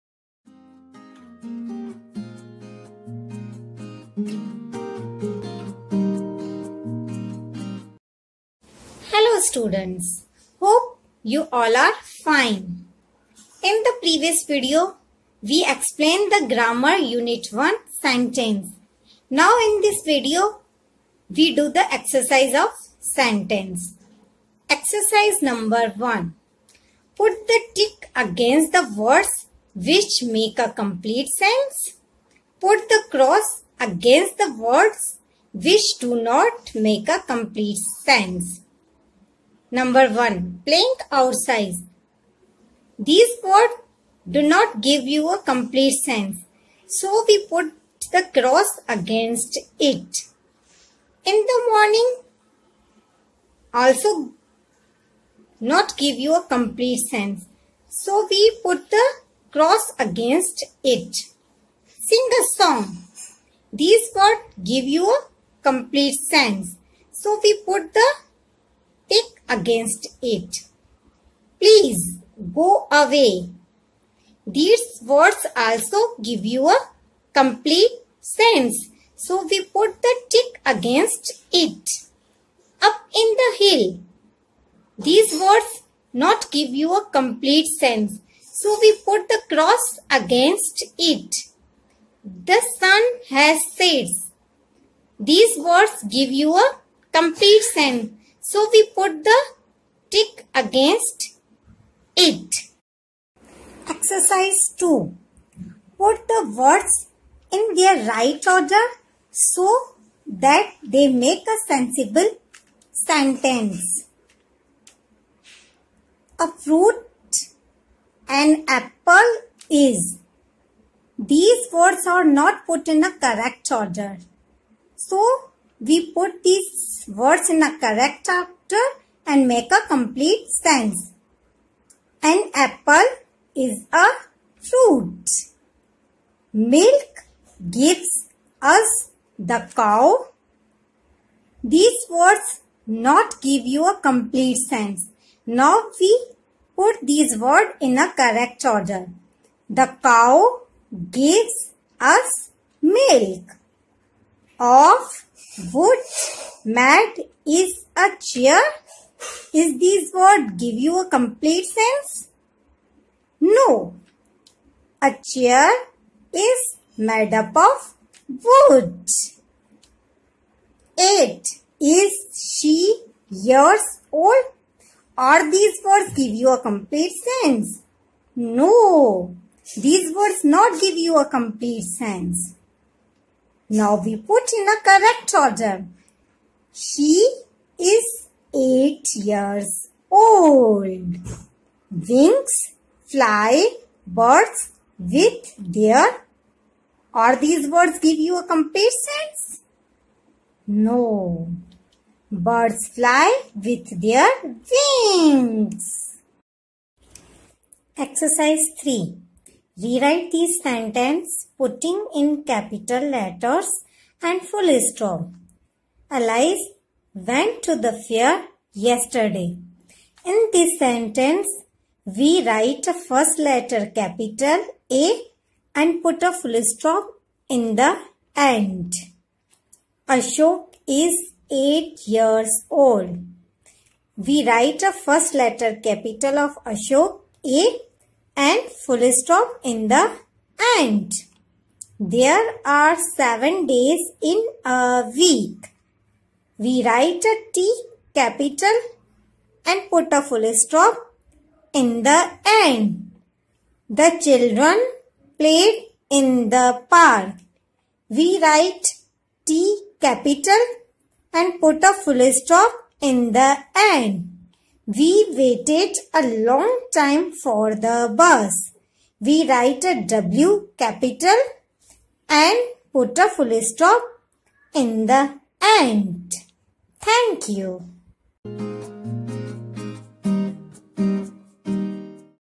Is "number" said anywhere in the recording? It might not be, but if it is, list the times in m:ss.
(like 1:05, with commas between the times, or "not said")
0:25, 0:39.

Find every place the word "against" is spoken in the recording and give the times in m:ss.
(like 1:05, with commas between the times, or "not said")
0:28, 0:33, 0:48, 0:59, 1:09, 1:20, 1:30, 1:40.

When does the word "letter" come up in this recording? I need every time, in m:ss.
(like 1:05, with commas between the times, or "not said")
3:33, 3:43, 3:55.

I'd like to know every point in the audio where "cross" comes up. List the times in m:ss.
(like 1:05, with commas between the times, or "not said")
0:33, 0:48, 0:59, 1:29.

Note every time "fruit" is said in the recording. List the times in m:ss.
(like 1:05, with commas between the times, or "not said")
1:56, 2:14.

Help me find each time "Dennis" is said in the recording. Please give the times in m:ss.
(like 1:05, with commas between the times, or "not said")
not said.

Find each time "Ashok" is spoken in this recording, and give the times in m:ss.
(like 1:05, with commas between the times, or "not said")
3:50, 3:56.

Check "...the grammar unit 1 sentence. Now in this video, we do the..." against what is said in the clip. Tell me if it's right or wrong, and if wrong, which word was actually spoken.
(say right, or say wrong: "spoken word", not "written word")
right.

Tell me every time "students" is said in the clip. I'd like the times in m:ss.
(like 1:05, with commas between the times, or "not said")
0:09.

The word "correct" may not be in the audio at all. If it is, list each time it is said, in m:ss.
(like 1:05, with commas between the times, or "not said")
2:03, 2:07, 2:28, 3:04.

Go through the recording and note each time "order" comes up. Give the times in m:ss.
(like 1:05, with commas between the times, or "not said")
1:48, 2:03, 2:08, 2:28, 3:05.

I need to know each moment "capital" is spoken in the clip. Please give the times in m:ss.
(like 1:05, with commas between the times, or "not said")
3:32, 3:43, 3:55, 4:08, 4:19, 4:30.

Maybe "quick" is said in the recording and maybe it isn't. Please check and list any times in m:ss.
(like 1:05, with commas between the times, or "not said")
not said.